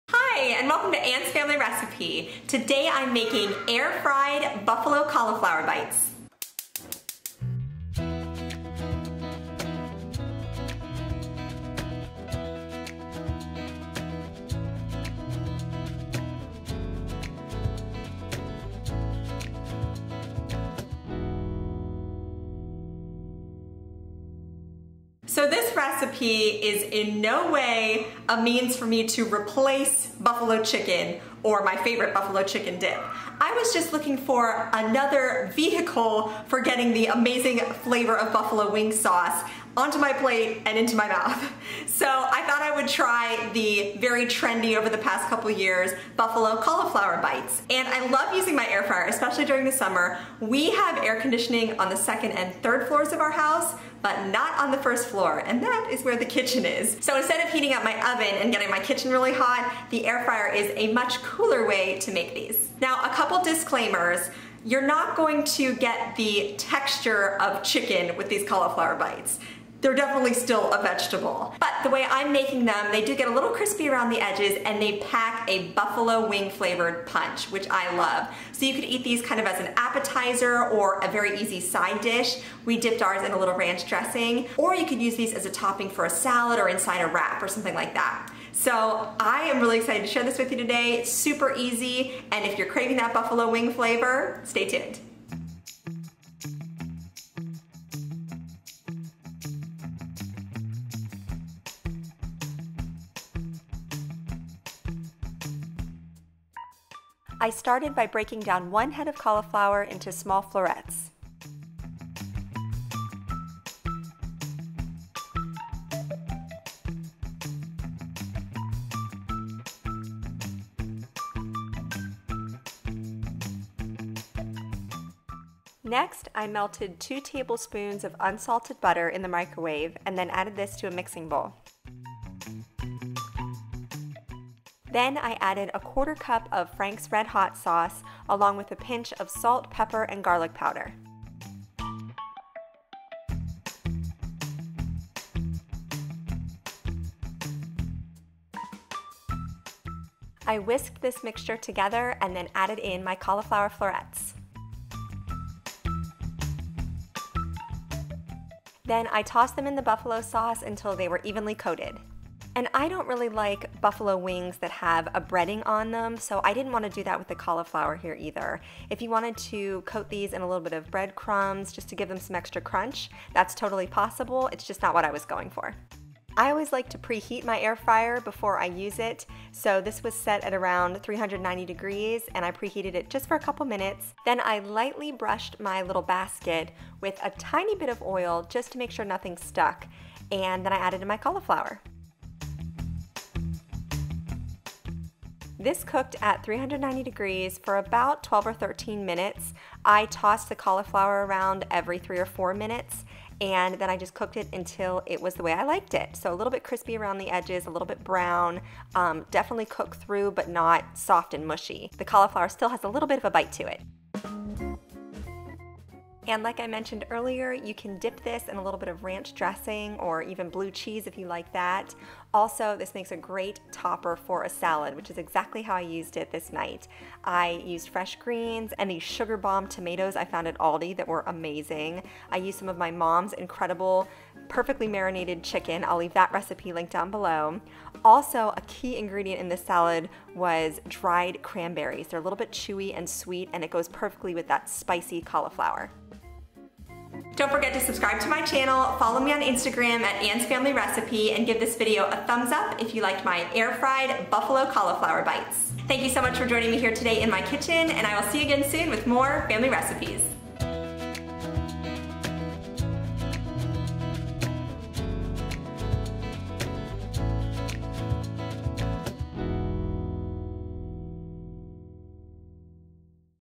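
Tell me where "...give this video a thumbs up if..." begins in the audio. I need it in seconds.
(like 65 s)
251 s.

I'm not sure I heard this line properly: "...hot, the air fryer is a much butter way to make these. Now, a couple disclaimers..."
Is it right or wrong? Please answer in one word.
wrong.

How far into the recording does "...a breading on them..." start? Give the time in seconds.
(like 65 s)
165 s.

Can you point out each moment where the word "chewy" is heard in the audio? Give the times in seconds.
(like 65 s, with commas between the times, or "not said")
242 s.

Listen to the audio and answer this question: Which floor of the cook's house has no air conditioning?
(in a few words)
first floor.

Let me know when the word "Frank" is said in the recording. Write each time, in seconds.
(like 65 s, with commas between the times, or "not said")
136 s.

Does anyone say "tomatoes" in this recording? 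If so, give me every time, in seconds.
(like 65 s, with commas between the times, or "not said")
229 s.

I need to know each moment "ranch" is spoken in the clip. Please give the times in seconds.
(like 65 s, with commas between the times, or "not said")
83 s, 219 s.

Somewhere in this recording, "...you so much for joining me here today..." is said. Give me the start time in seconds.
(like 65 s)
256 s.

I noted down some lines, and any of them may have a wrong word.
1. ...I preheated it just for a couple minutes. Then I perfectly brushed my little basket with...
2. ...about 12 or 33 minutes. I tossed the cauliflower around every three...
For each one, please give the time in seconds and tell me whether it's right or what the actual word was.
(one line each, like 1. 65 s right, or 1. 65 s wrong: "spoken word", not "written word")
1. 182 s wrong: "lightly", not "perfectly"
2. 197 s wrong: "13", not "33".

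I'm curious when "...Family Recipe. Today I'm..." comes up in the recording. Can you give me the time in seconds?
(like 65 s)
1 s.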